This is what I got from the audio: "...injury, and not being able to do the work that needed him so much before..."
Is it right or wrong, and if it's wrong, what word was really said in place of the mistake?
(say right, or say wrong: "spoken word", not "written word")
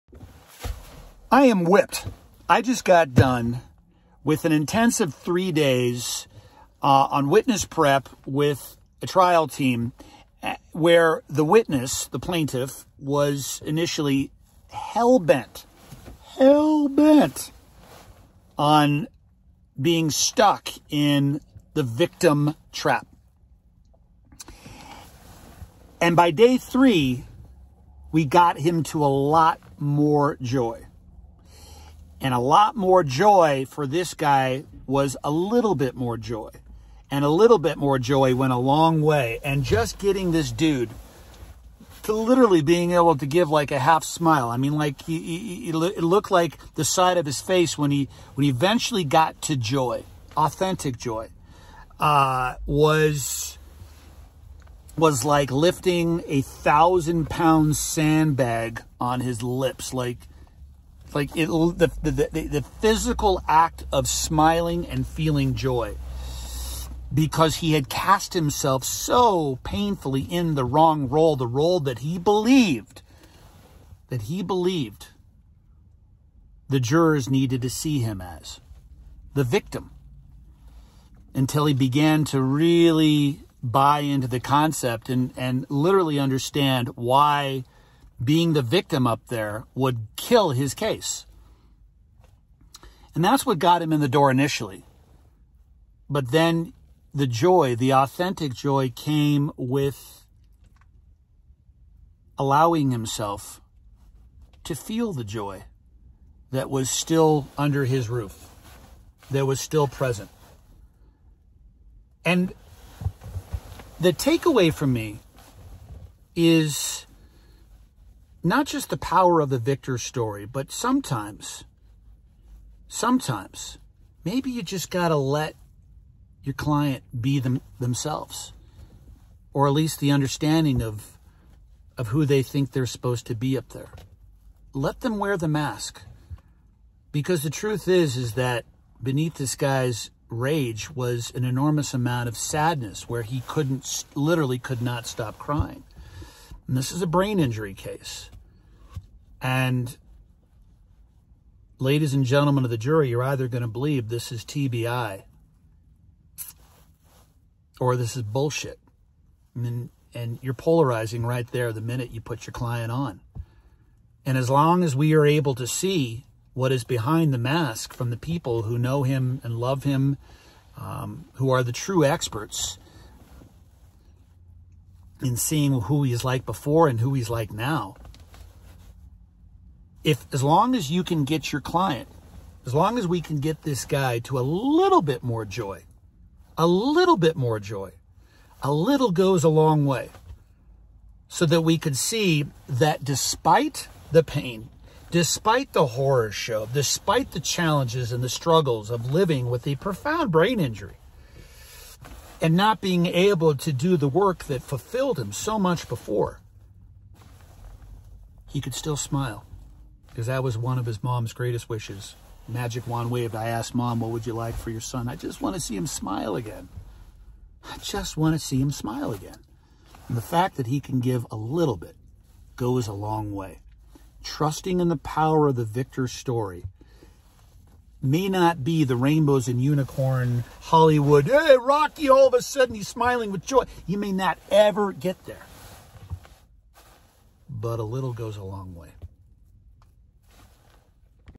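wrong: "fulfilled", not "needed".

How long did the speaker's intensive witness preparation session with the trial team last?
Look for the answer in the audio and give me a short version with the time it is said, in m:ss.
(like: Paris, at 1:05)
three days, at 0:05.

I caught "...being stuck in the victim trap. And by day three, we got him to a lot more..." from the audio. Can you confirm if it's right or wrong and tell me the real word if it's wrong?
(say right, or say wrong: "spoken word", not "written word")
right.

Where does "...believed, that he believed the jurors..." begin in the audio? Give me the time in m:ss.
1:12.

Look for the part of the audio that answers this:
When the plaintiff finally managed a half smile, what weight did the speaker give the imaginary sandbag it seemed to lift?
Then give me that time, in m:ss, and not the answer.
0:56.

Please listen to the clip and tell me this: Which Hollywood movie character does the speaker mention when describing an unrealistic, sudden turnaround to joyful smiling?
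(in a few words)
Rocky.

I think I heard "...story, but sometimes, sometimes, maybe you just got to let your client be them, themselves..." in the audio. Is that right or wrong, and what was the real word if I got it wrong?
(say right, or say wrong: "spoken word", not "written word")
right.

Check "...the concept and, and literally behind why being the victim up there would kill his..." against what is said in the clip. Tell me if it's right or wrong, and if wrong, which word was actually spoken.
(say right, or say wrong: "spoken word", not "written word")
wrong: "understand", not "behind".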